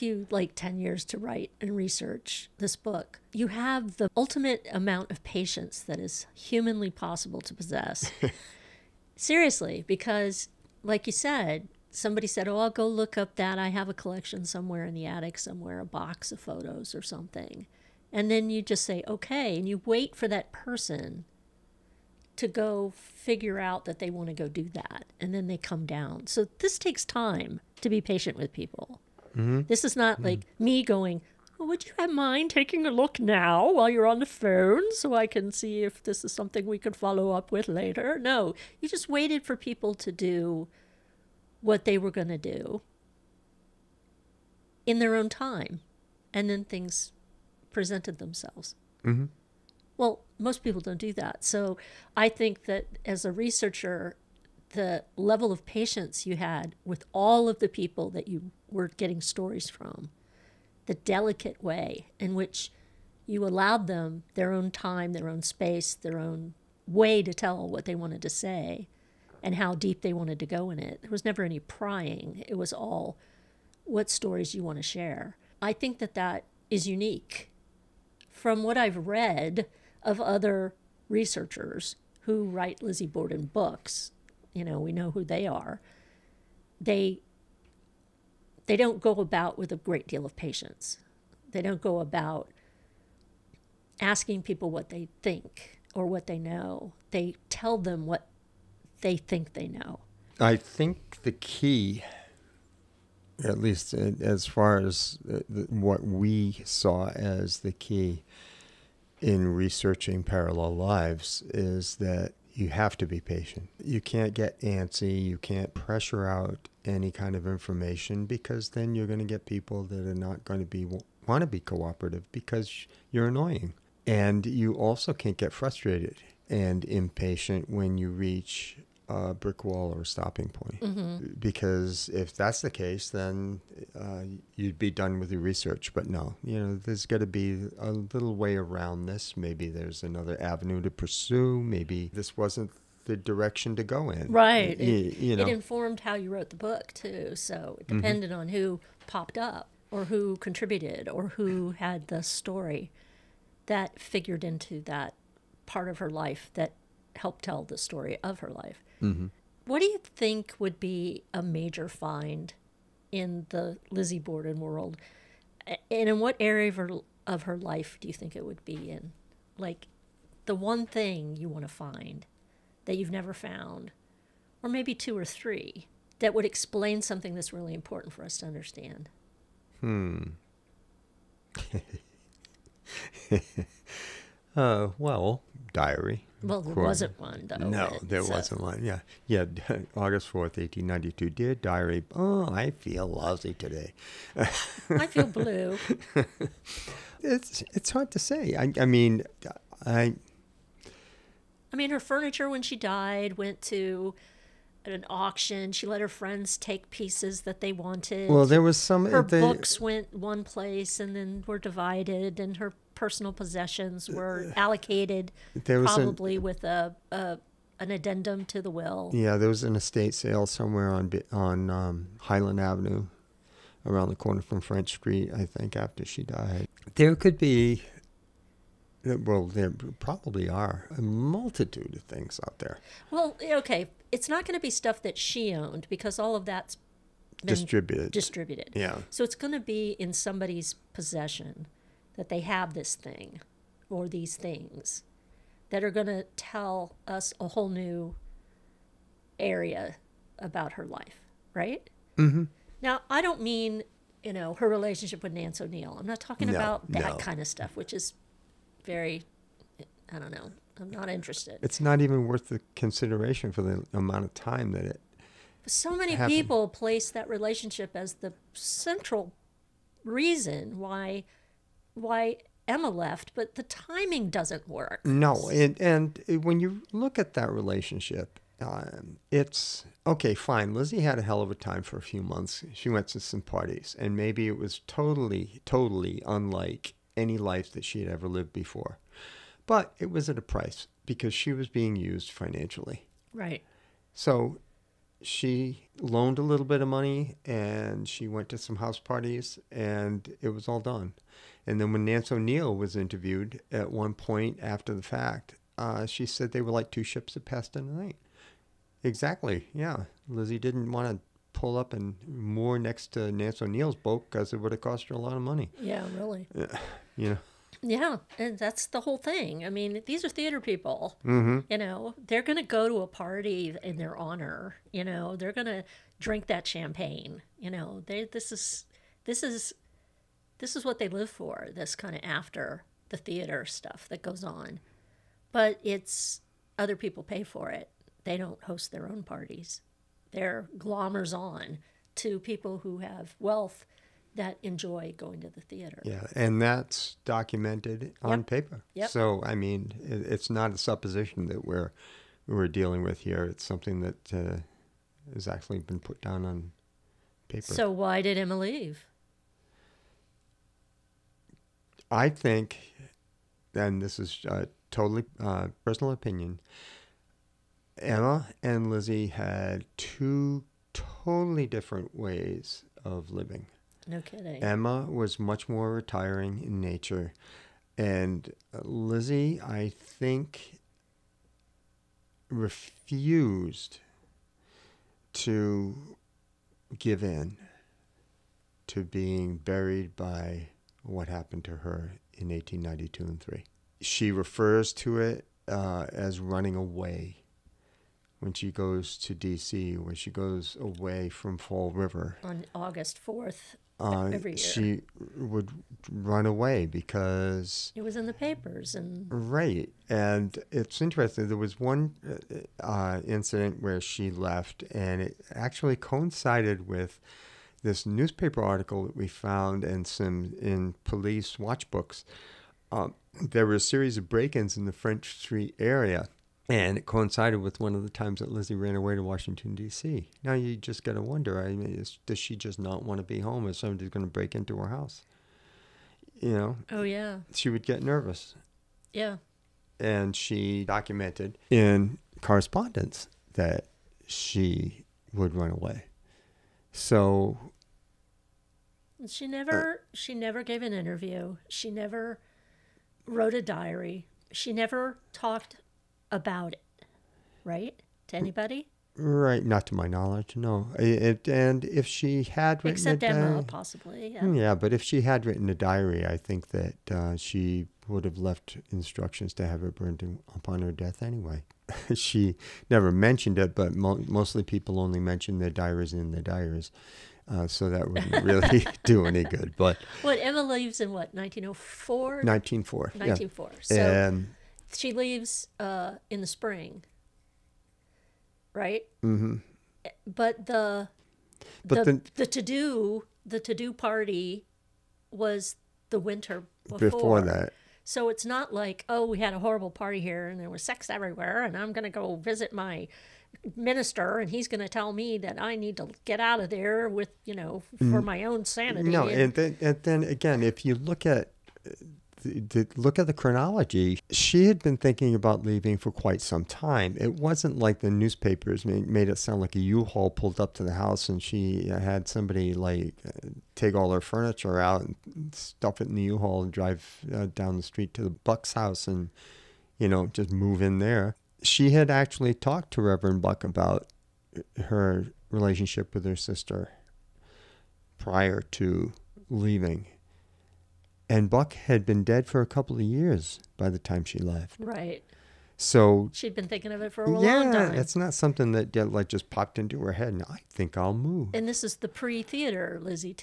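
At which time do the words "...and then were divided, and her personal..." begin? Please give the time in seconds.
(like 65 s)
210 s.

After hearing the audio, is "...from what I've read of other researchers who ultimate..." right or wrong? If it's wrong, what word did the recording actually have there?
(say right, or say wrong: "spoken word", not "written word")
wrong: "write", not "ultimate".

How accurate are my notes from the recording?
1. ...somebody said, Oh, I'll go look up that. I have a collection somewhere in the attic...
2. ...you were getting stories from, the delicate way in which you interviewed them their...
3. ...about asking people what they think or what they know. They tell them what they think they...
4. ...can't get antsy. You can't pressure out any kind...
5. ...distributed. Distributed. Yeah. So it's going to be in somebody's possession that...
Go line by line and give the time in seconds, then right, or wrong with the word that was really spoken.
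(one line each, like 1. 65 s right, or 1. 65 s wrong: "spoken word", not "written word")
1. 11 s right
2. 58 s wrong: "allowed", not "interviewed"
3. 91 s right
4. 114 s right
5. 237 s right.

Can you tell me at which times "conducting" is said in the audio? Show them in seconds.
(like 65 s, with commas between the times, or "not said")
not said.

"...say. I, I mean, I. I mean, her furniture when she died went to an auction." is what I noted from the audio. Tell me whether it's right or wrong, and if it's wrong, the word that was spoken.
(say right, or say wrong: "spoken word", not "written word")
right.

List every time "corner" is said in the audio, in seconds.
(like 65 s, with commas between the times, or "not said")
224 s.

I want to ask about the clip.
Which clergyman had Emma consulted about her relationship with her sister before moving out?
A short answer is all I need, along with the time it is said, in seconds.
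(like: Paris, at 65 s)
Reverend Buck, at 533 s.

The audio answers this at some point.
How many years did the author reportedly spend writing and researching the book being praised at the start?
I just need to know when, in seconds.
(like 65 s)
0 s.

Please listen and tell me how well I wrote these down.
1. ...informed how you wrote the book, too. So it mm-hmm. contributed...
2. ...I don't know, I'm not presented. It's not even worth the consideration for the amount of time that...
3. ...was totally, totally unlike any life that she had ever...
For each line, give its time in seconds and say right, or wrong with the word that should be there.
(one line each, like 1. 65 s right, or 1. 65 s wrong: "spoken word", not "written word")
1. 145 s wrong: "depended", not "contributed"
2. 260 s wrong: "interested", not "presented"
3. 284 s right.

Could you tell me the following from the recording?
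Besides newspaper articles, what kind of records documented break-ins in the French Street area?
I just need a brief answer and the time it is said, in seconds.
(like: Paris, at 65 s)
Police watch books, at 421 s.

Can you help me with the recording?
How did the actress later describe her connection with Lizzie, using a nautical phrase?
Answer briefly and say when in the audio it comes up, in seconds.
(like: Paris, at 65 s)
Two ships that passed in the night, at 306 s.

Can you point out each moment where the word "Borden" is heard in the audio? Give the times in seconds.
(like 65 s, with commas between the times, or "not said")
83 s, 164 s.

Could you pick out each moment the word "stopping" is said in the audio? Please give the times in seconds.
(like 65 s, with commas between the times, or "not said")
130 s.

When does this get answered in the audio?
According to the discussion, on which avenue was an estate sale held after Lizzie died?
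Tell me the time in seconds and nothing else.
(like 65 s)
222 s.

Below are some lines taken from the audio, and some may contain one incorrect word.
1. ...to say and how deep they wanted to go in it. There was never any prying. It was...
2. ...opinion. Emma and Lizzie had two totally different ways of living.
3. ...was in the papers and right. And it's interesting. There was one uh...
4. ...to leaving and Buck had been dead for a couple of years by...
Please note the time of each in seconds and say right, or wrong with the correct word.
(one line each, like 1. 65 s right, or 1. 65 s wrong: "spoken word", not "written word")
1. 68 s right
2. 366 s right
3. 408 s right
4. 538 s right.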